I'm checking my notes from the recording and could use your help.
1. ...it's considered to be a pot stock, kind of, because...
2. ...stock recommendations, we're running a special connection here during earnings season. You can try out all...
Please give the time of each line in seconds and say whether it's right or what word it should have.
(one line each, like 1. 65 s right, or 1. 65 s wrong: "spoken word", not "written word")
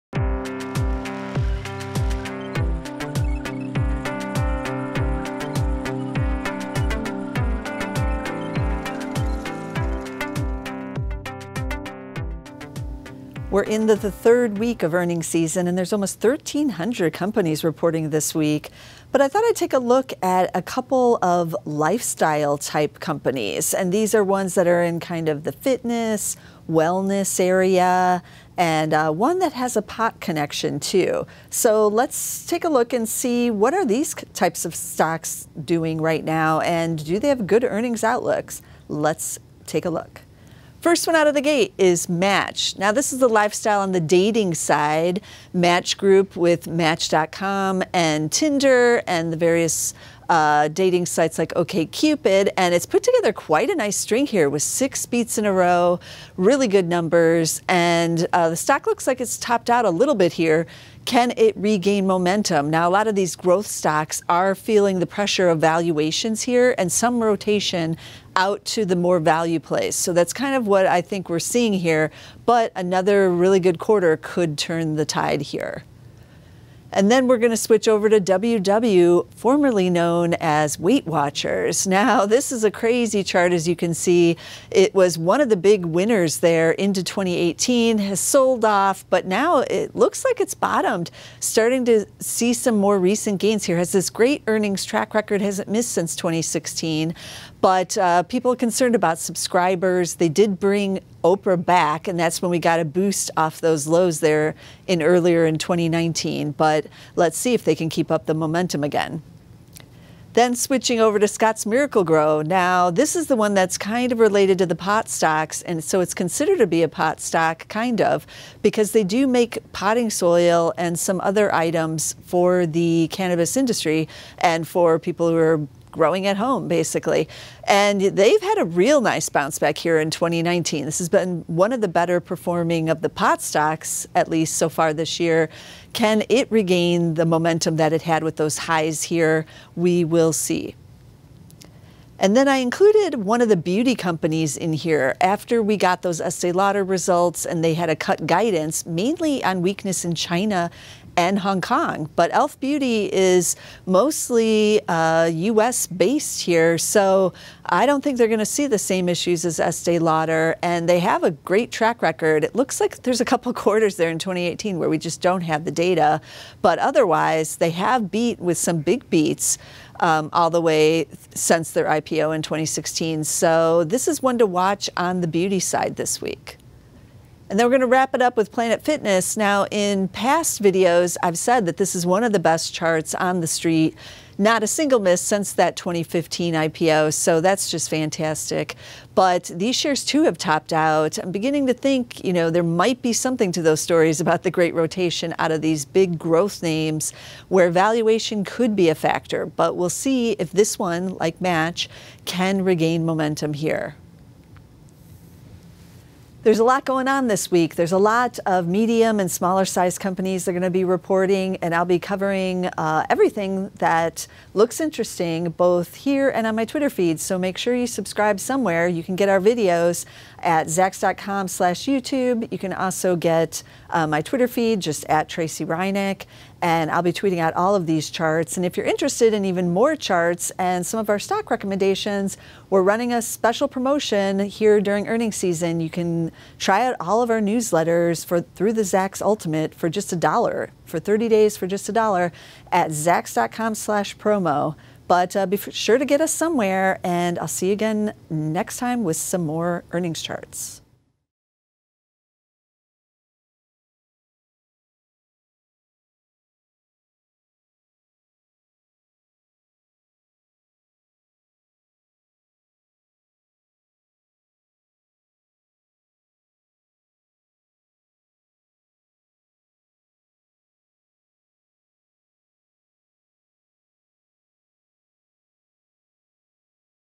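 1. 115 s right
2. 231 s wrong: "promotion", not "connection".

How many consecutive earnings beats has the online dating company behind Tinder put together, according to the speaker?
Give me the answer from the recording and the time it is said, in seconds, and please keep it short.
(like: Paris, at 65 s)
6, at 54 s.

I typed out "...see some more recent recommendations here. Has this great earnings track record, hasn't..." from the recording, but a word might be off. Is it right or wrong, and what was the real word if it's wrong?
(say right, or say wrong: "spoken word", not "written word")
wrong: "gains", not "recommendations".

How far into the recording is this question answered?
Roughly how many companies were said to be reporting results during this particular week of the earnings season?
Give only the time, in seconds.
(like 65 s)
16 s.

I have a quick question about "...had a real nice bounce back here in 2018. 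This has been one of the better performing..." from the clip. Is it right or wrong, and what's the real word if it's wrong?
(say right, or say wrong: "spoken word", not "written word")
wrong: "2019", not "2018".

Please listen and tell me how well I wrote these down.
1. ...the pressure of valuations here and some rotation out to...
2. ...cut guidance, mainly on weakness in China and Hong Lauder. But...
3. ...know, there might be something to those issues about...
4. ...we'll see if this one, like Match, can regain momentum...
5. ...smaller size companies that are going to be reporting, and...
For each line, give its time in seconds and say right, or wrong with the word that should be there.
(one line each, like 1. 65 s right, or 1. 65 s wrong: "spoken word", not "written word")
1. 64 s right
2. 147 s wrong: "Kong", not "Lauder"
3. 192 s wrong: "stories", not "issues"
4. 199 s right
5. 209 s right.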